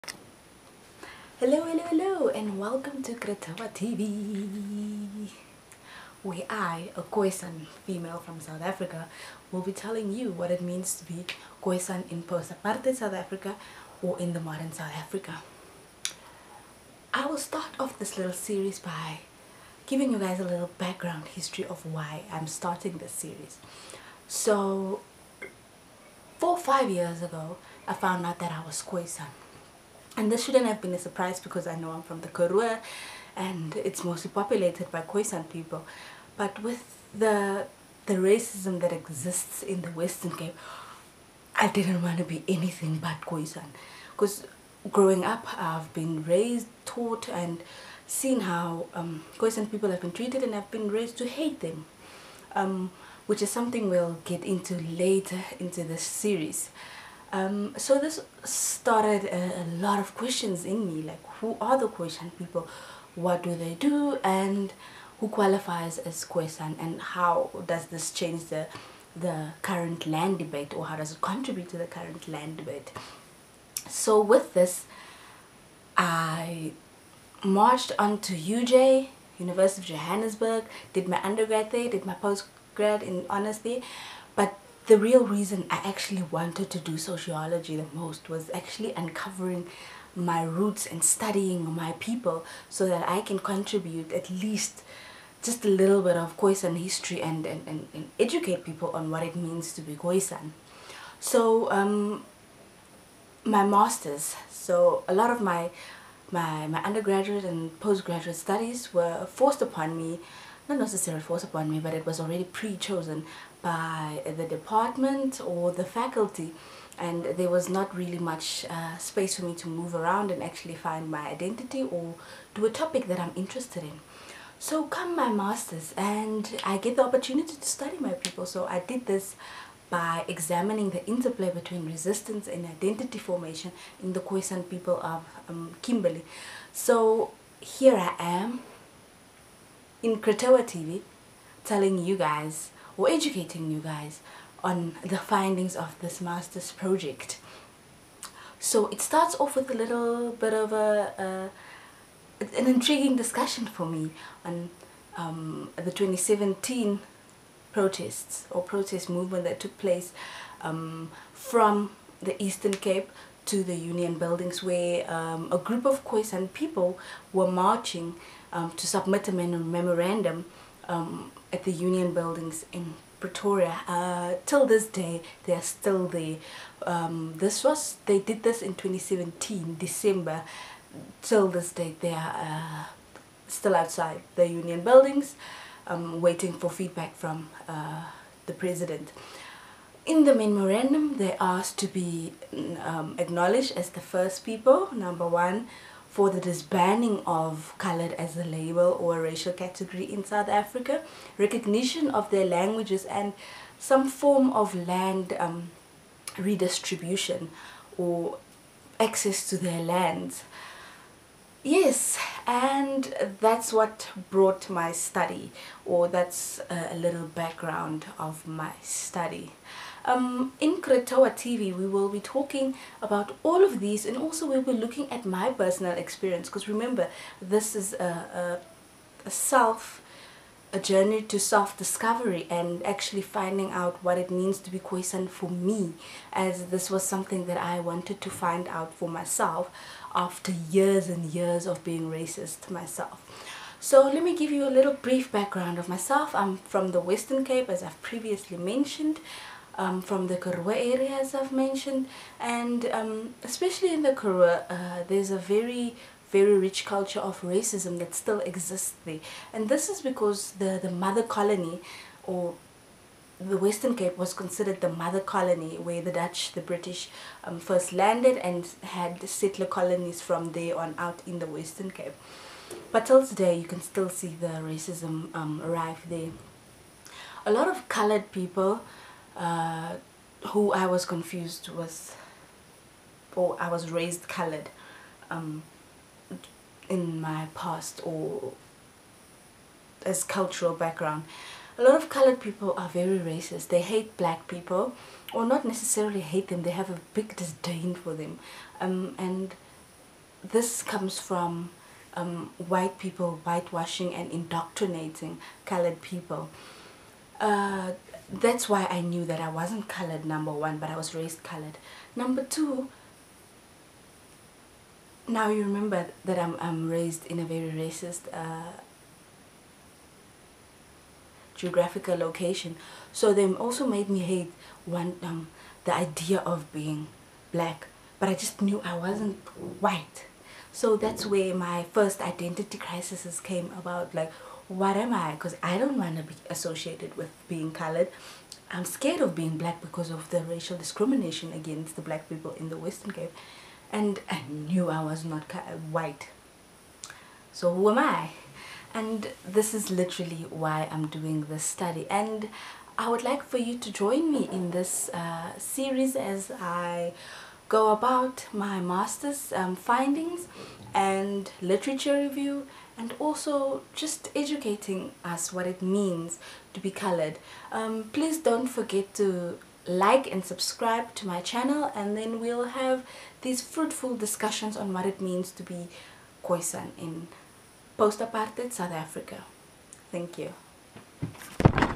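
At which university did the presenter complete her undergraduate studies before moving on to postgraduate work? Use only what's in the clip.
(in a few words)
University of Johannesburg.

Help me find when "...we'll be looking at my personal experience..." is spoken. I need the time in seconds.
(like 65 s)
224 s.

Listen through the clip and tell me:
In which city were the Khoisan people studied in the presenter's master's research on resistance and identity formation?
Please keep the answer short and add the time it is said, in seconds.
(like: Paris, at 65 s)
Kimberley, at 135 s.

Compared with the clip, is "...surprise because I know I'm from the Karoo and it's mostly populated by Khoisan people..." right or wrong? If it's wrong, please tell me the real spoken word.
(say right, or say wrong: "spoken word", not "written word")
right.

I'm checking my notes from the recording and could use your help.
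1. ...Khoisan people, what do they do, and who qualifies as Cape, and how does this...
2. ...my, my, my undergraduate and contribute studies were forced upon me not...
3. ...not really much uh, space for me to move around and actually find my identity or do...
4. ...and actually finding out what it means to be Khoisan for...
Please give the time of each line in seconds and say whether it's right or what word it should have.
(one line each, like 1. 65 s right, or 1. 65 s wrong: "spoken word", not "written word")
1. 61 s wrong: "Khoisan", not "Cape"
2. 105 s wrong: "postgraduate", not "contribute"
3. 117 s right
4. 232 s right.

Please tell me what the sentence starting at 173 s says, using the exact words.
Uh, till this day, they are still there.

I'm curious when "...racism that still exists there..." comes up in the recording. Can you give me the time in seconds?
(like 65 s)
257 s.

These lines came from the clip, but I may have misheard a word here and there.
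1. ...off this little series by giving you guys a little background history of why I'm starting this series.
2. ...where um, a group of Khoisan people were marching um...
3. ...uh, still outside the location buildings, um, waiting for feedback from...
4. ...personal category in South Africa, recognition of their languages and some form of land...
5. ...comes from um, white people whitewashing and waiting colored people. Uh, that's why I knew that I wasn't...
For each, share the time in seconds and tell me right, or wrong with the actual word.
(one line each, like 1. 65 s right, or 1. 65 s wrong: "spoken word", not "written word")
1. 17 s right
2. 164 s right
3. 182 s wrong: "union", not "location"
4. 199 s wrong: "racial", not "personal"
5. 300 s wrong: "indoctrinating", not "waiting".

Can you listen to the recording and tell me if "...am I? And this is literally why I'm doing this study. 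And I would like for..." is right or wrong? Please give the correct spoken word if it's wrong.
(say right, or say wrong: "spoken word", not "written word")
right.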